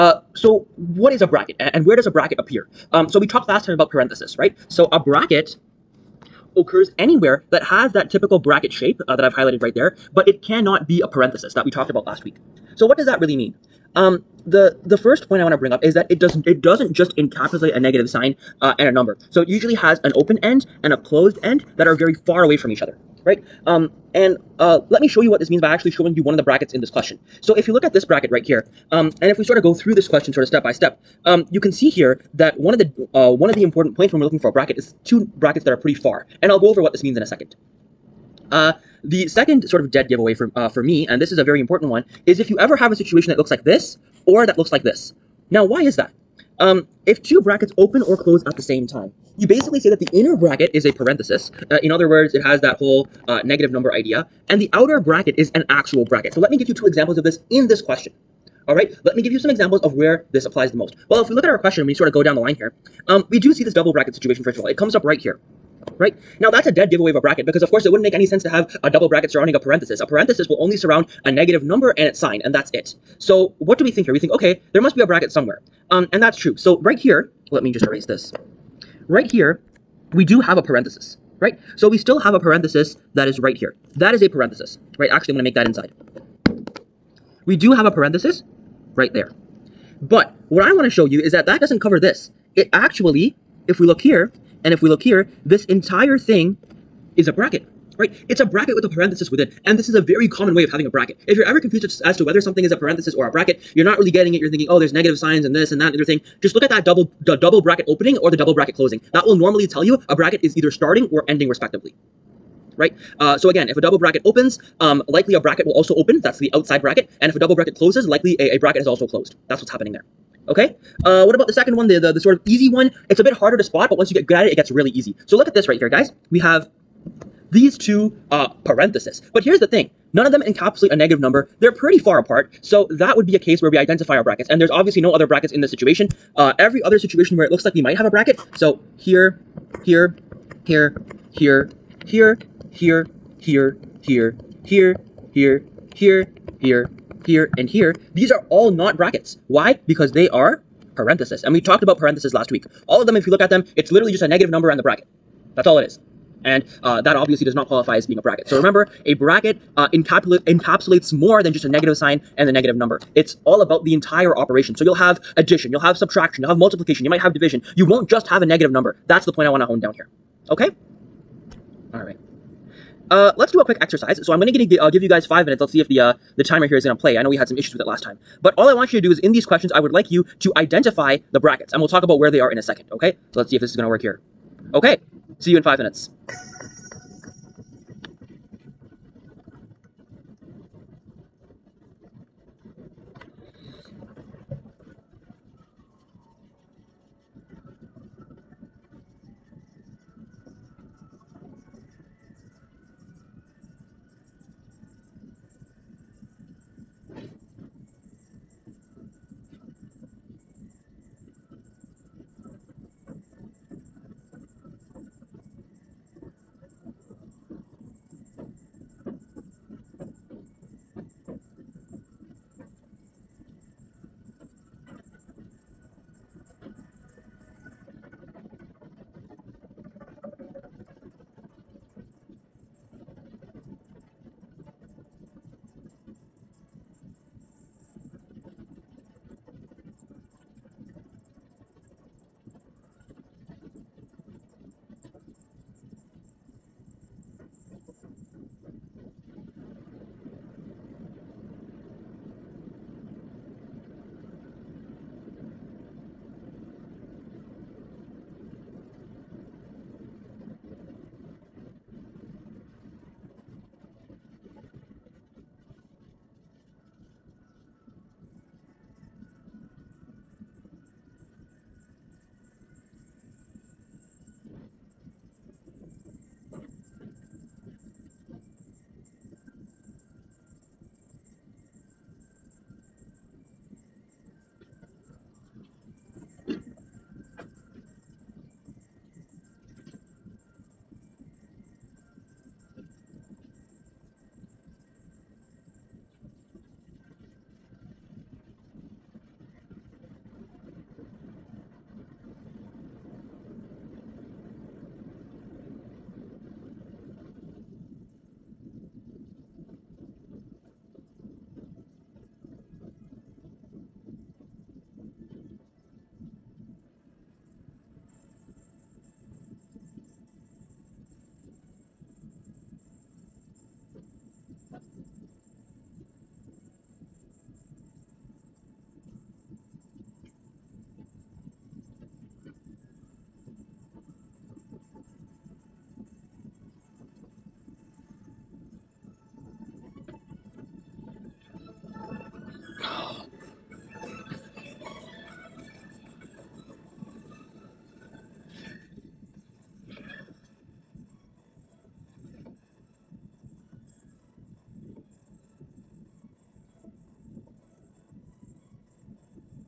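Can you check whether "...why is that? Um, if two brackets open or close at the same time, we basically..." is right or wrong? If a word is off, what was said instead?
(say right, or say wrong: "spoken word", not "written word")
right.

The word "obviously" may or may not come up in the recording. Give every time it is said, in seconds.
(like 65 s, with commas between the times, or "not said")
134 s, 157 s.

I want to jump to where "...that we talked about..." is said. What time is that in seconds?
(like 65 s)
11 s.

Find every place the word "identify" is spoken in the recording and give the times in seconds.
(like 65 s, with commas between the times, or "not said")
133 s, 180 s.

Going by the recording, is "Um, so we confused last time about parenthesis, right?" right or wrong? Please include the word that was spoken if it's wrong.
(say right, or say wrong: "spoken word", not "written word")
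wrong: "talked", not "confused".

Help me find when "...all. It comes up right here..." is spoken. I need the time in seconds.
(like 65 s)
64 s.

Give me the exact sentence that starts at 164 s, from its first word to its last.
So you'll have addition, you'll have subtraction, you'll have multiplication, you might have division.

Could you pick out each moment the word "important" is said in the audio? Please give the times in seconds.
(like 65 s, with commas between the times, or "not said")
33 s, 41 s.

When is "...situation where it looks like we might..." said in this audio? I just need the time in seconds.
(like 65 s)
136 s.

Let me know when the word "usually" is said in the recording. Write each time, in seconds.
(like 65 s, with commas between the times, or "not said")
19 s.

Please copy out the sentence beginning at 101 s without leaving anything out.
If you're ever confused as to whether something is a parenthesis or a bracket, you're not really getting it.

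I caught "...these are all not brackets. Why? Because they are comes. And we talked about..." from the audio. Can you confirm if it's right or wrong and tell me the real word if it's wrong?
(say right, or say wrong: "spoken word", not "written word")
wrong: "parentheses", not "comes".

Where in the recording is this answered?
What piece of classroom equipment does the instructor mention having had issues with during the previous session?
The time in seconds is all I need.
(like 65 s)
176 s.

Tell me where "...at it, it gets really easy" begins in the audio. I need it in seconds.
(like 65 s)
124 s.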